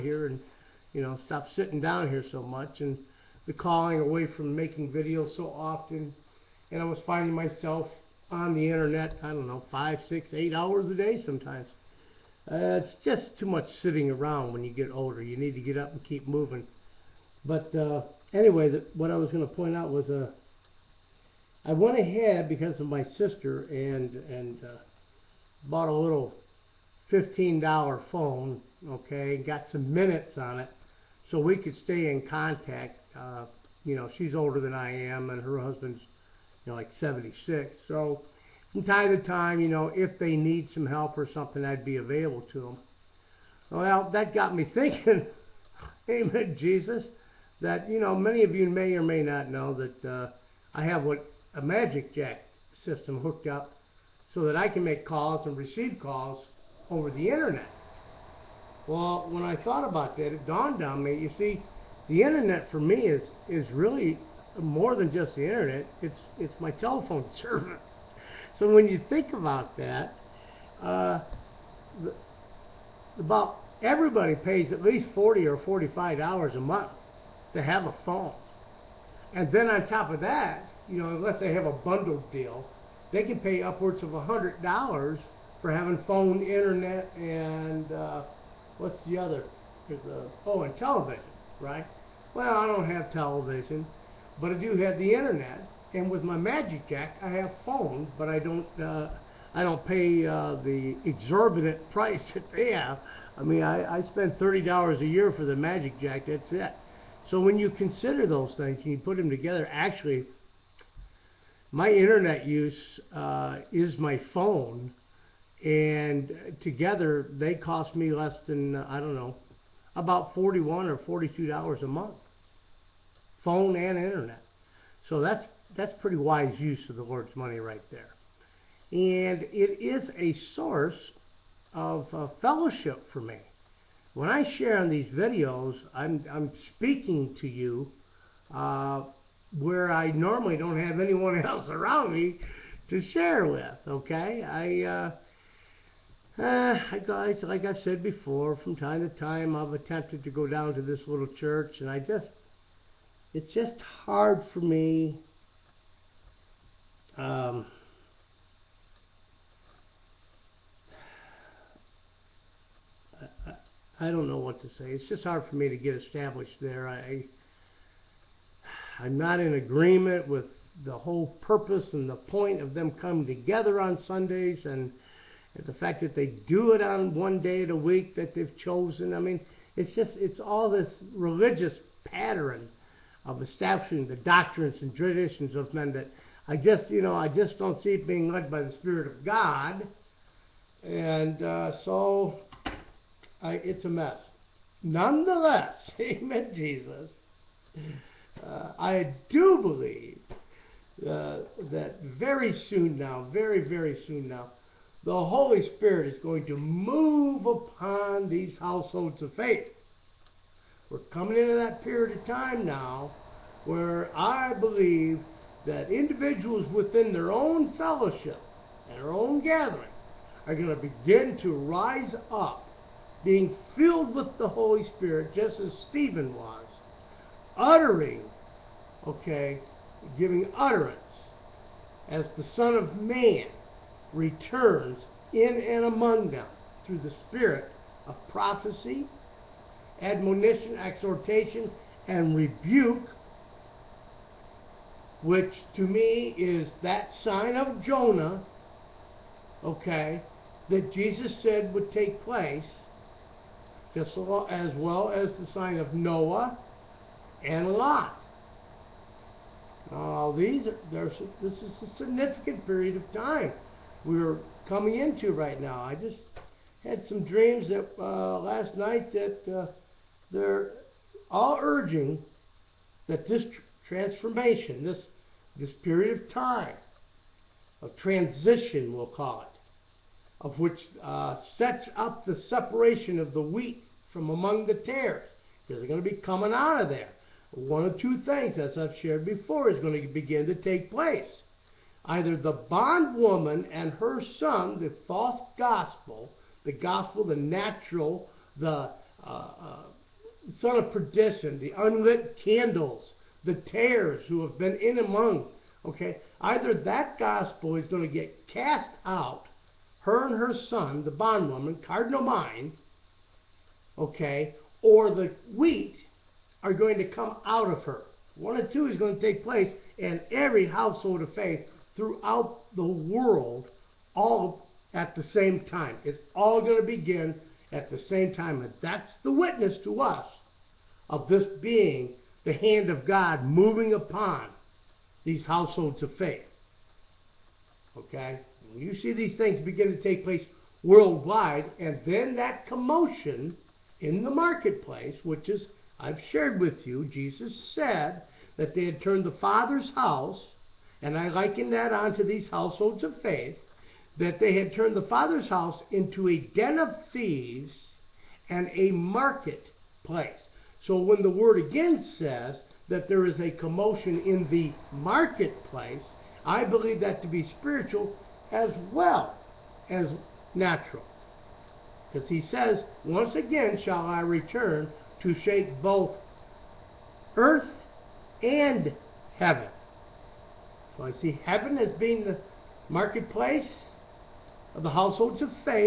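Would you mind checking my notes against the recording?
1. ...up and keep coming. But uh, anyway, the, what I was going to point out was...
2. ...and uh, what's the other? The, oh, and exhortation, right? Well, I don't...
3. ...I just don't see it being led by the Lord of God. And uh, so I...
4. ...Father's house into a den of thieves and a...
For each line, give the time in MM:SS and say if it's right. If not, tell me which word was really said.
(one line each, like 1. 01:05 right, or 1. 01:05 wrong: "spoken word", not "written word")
1. 00:15 wrong: "moving", not "coming"
2. 01:27 wrong: "television", not "exhortation"
3. 03:07 wrong: "Spirit", not "Lord"
4. 05:55 right.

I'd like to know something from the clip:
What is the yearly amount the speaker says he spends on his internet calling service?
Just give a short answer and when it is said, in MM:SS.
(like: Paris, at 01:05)
$30, at 01:44.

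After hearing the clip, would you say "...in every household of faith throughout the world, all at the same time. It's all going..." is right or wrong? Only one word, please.
right.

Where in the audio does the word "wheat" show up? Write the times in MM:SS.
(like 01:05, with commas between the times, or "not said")
04:43, 05:15.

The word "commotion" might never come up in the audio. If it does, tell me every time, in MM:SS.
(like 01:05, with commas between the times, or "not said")
05:42, 06:03.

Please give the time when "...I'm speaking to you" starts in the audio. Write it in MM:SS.
02:16.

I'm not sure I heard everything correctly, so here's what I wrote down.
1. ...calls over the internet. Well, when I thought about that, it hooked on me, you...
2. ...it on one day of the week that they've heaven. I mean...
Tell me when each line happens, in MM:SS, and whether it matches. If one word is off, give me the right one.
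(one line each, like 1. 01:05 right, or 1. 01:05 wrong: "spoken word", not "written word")
1. 00:56 wrong: "dawned", not "hooked"
2. 02:56 wrong: "chosen", not "heaven".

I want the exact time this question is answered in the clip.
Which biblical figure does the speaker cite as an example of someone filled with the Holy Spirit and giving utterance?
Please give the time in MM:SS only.
03:45.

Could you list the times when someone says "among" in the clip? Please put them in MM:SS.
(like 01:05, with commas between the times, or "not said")
03:55, 04:44, 05:04.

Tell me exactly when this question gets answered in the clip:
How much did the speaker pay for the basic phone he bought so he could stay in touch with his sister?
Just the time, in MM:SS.
00:27.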